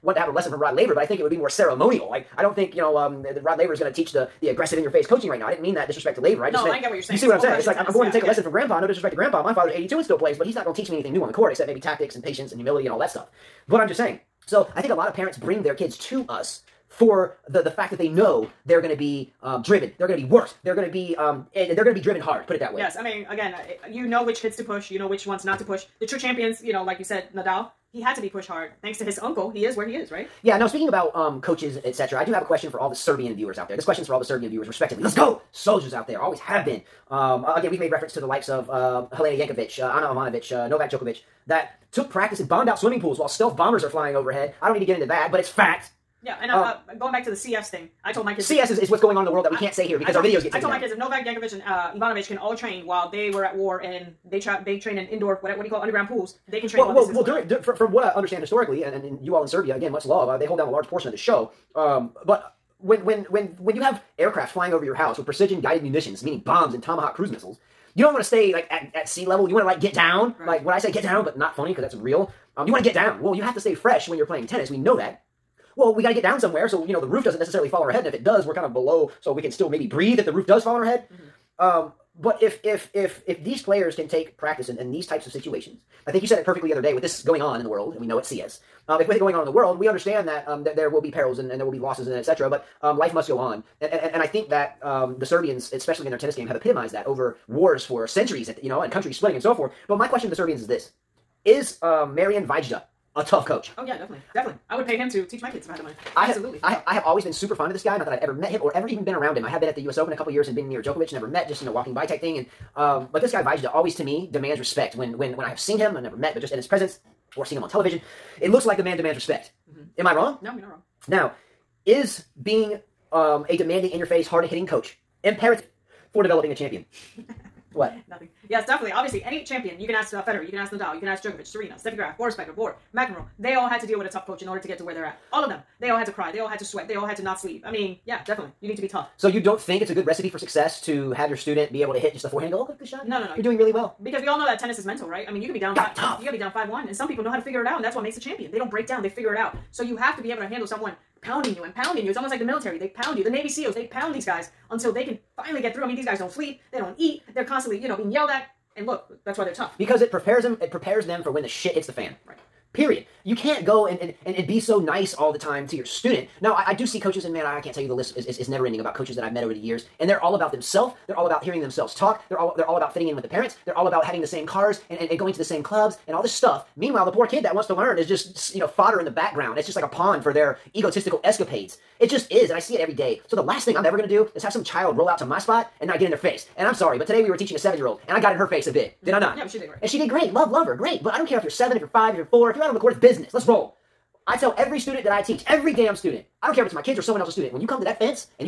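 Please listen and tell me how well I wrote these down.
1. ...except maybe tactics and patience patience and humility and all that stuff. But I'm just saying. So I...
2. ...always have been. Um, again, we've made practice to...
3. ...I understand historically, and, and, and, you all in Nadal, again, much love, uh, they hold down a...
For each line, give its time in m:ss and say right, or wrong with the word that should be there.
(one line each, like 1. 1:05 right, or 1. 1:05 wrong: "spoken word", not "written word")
1. 0:11 right
2. 0:36 wrong: "reference", not "practice"
3. 0:58 wrong: "Serbia", not "Nadal".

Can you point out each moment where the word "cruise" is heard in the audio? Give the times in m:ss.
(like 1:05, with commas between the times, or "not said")
1:07.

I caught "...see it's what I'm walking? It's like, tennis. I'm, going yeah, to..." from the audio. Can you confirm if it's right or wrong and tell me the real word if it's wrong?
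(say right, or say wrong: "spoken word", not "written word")
wrong: "saying", not "walking".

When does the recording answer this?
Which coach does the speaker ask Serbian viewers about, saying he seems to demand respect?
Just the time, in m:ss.
1:42.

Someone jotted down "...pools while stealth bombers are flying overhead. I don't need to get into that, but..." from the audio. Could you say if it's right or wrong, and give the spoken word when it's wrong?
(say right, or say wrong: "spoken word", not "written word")
right.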